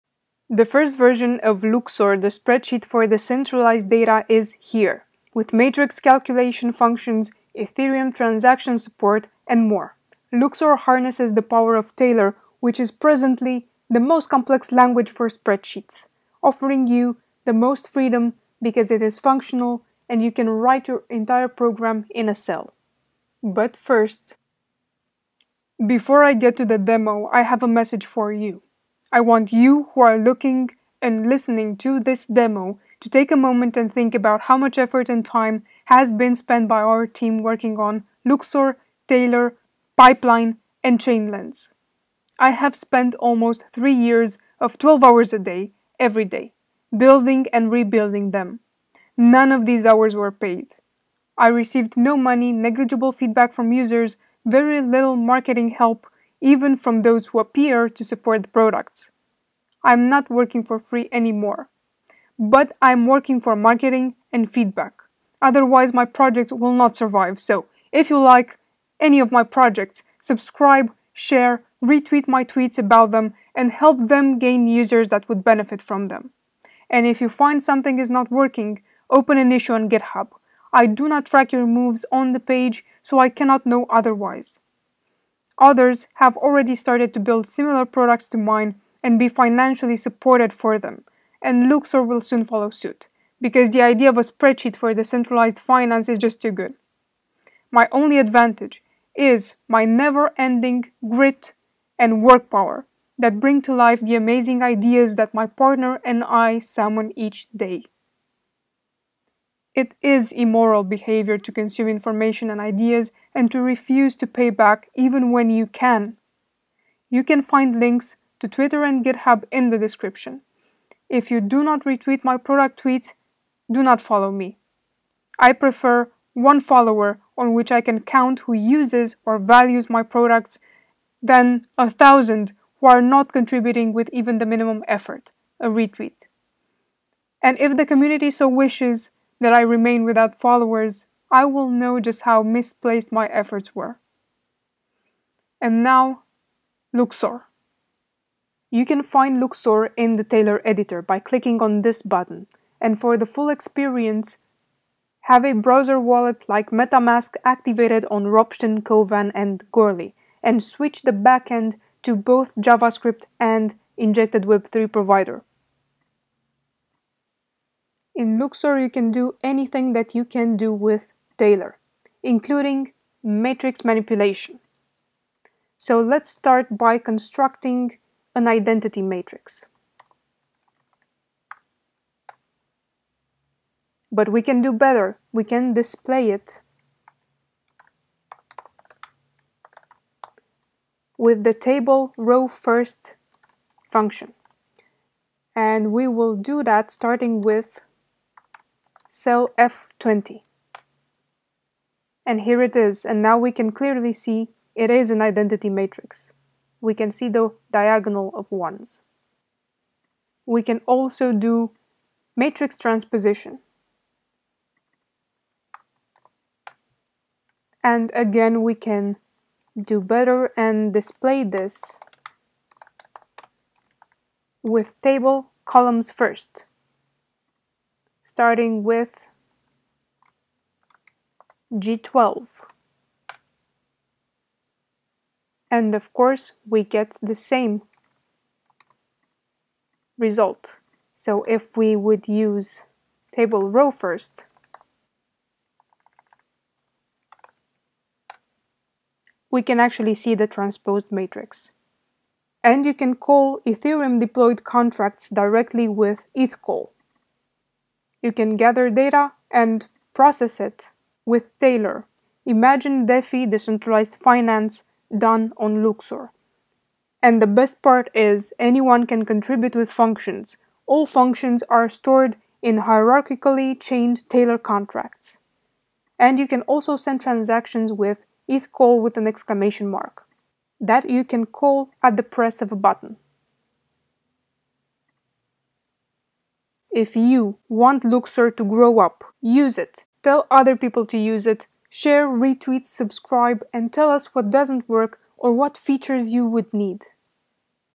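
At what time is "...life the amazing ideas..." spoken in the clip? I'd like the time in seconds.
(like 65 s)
103 s.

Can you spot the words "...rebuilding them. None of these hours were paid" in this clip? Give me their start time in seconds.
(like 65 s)
47 s.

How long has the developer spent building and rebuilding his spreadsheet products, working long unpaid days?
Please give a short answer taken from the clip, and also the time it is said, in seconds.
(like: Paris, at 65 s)
almost 3 years, at 43 s.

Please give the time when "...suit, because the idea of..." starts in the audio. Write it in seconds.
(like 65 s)
92 s.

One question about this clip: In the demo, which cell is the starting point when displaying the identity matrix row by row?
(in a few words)
F20.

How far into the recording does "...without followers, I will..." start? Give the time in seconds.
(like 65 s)
140 s.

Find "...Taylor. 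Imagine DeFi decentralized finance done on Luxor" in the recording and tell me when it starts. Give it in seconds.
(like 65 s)
261 s.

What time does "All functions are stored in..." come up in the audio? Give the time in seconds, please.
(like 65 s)
270 s.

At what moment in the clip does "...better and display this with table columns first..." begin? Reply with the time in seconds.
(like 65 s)
219 s.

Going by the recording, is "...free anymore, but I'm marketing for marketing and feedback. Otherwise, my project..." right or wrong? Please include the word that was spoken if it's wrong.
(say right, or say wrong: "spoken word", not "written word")
wrong: "working", not "marketing".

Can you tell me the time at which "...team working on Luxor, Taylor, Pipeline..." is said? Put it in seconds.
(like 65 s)
37 s.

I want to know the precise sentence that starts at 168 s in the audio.
In Luxor, you can do anything that you can do with Taylor, including matrix manipulation.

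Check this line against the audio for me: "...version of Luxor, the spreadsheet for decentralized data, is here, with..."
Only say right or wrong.
right.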